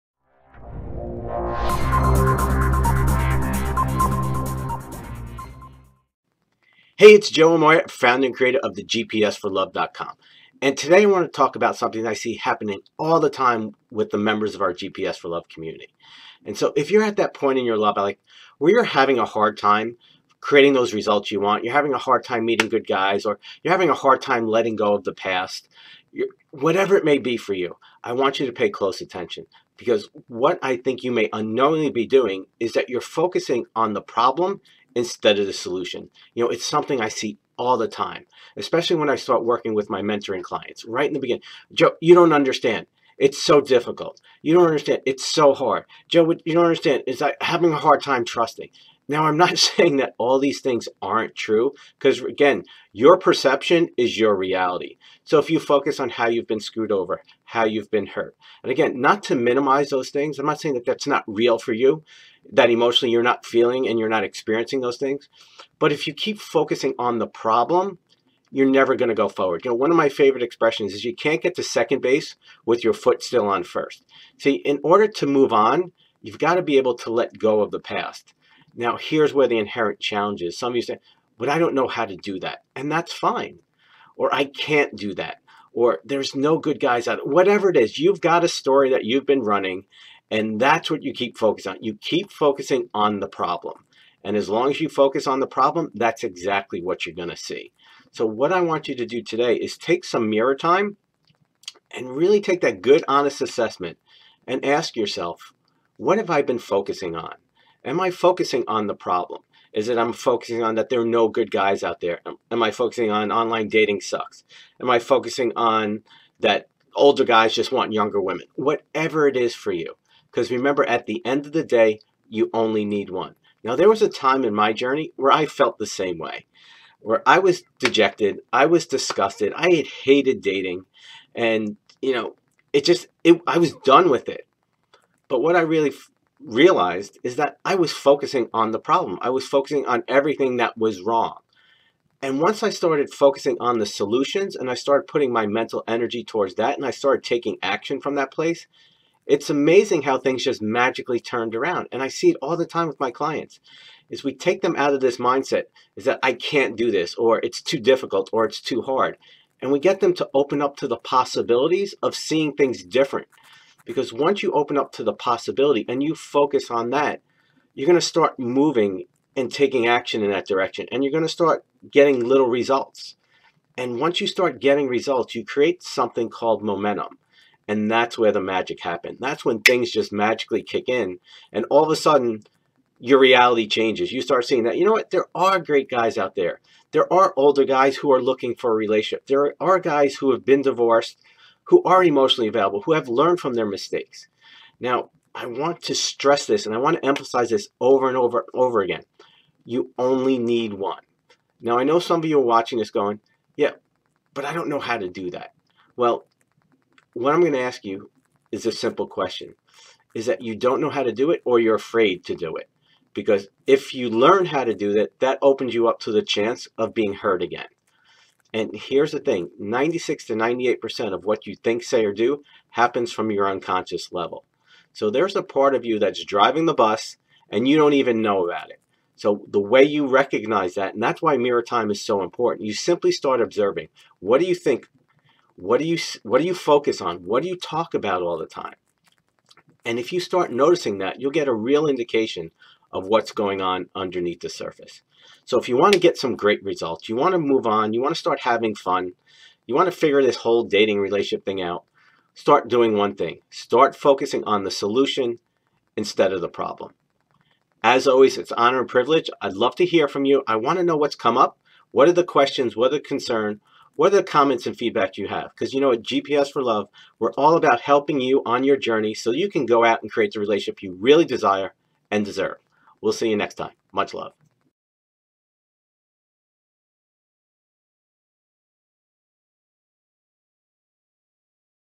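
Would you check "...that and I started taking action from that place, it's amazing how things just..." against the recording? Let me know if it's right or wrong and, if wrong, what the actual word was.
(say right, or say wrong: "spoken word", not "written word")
right.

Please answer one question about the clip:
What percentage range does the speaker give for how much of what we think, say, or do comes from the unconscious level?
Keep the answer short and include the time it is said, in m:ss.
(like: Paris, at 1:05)
96 to 98%, at 3:39.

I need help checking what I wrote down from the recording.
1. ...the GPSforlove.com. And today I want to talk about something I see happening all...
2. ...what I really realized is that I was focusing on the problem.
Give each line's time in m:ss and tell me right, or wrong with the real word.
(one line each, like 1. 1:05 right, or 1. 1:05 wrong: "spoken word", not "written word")
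1. 0:08 right
2. 2:15 right.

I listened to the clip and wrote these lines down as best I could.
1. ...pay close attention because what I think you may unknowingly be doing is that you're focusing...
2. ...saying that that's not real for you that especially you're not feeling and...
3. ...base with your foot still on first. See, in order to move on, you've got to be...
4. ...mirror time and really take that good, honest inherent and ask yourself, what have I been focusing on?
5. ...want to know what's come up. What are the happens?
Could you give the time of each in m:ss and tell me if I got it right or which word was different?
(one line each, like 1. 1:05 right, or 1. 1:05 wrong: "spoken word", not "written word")
1. 0:28 right
2. 1:00 wrong: "emotionally", not "especially"
3. 1:12 right
4. 1:40 wrong: "assessment", not "inherent"
5. 4:20 wrong: "questions", not "happens".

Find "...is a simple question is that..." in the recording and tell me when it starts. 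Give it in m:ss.
3:28.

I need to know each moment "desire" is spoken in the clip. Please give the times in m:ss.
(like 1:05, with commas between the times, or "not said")
4:31.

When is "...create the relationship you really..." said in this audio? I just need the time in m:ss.
4:30.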